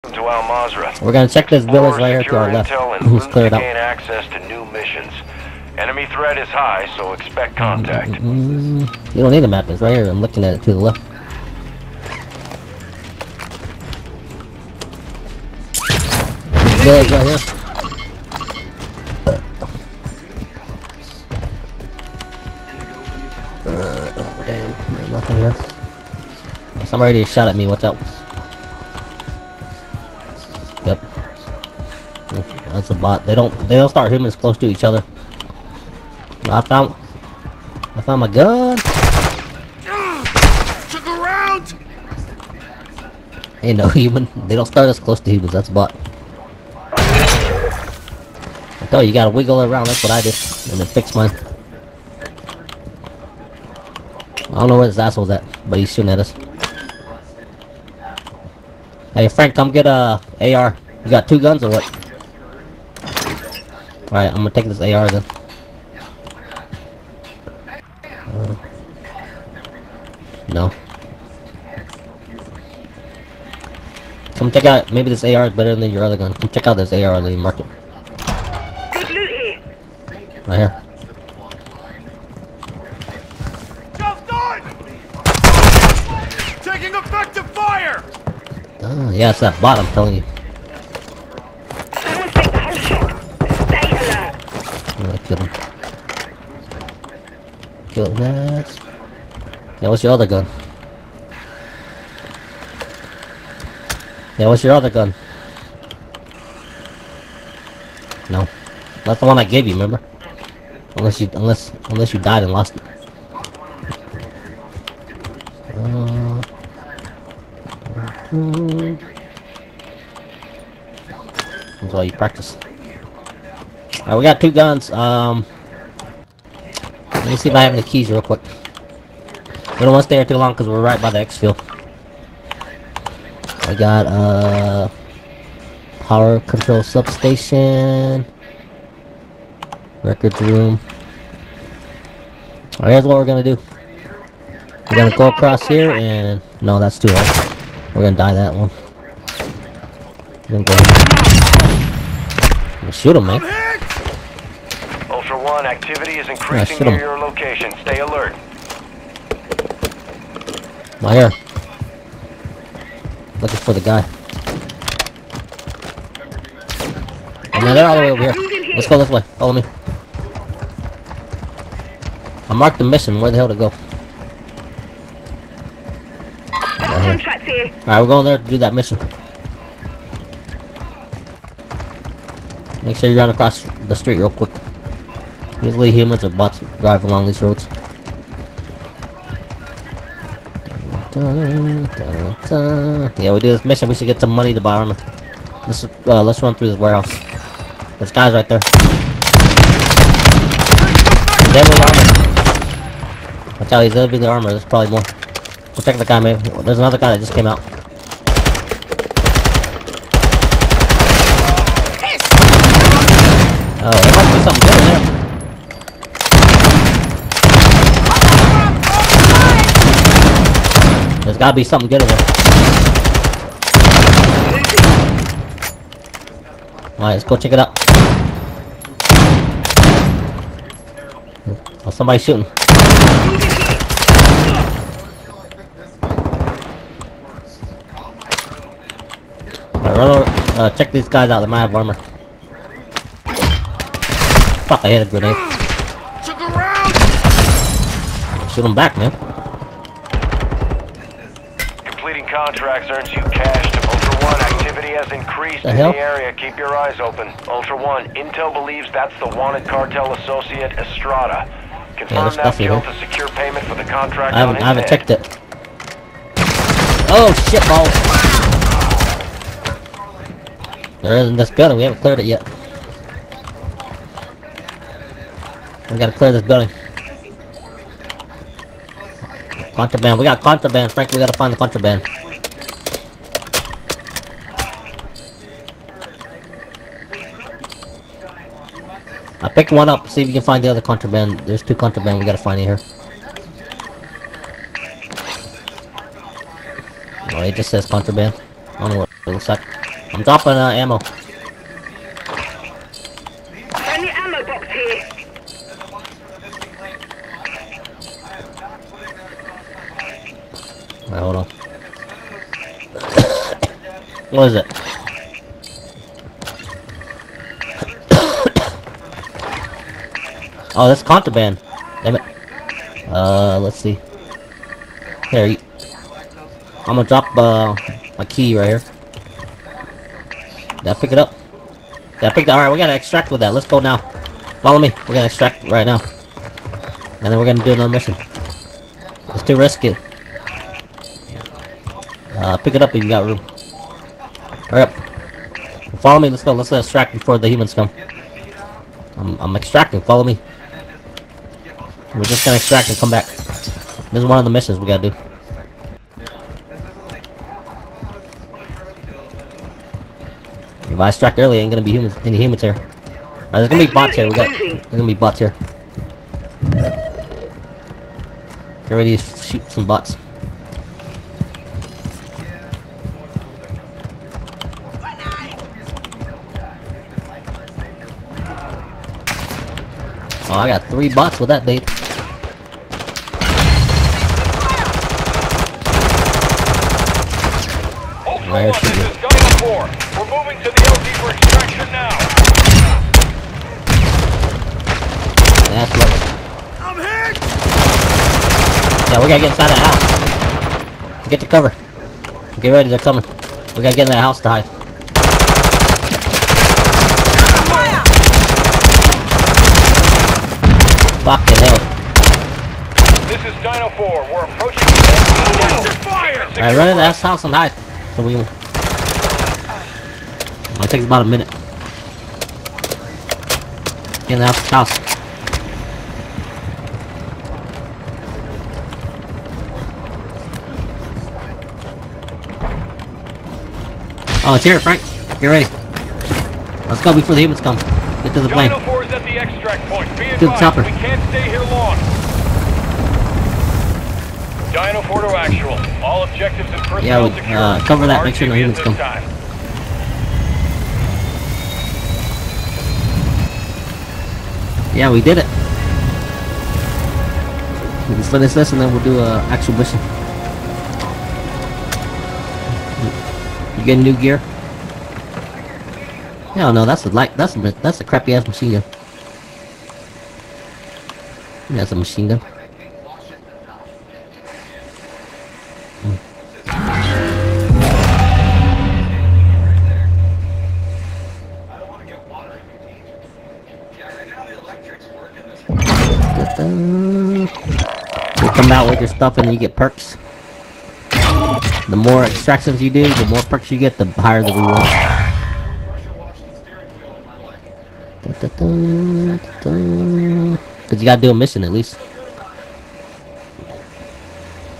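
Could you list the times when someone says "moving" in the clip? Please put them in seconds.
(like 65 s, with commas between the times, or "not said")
388 s.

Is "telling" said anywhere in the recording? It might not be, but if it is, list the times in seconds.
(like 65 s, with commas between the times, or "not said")
89 s.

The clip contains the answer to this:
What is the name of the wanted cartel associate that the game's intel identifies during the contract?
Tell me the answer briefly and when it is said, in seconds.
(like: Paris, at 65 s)
Estrada, at 260 s.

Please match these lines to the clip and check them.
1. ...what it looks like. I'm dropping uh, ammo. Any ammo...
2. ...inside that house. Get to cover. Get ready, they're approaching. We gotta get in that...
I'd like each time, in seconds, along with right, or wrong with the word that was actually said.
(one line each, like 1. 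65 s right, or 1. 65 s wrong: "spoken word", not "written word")
1. 298 s right
2. 399 s wrong: "coming", not "approaching".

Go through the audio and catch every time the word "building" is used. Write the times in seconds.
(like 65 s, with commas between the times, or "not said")
271 s, 276 s.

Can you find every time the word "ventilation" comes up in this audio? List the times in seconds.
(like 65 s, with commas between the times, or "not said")
not said.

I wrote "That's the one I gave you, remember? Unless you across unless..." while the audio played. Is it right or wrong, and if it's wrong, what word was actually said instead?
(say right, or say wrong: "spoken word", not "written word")
wrong: "unless", not "across".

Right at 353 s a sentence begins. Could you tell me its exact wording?
This is one of the missions we gotta do.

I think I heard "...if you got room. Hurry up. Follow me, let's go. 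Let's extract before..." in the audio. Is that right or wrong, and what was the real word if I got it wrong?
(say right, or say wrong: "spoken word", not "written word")
right.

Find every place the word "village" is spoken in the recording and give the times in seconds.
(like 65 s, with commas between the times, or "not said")
1 s, 16 s.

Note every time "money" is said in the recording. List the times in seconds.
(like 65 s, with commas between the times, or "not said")
194 s.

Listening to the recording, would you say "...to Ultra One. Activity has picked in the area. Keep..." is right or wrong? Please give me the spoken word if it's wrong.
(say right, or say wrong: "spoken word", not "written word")
wrong: "increased", not "picked".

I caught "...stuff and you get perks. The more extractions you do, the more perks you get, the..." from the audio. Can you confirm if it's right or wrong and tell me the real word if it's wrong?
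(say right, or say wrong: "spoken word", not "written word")
right.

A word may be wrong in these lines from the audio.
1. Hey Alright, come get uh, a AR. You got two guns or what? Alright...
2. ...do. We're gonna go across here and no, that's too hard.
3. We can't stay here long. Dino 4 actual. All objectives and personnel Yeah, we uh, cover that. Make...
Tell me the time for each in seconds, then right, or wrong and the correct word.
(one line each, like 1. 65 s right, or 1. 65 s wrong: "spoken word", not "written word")
1. 59 s wrong: "Frank", not "Alright"
2. 143 s right
3. 440 s right.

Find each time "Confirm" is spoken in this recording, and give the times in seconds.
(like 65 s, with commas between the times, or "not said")
261 s.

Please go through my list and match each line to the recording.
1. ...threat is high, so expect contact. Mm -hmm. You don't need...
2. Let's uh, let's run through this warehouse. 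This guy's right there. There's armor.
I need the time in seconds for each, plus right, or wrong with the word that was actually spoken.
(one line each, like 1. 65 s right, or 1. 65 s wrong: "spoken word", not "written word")
1. 6 s right
2. 195 s right.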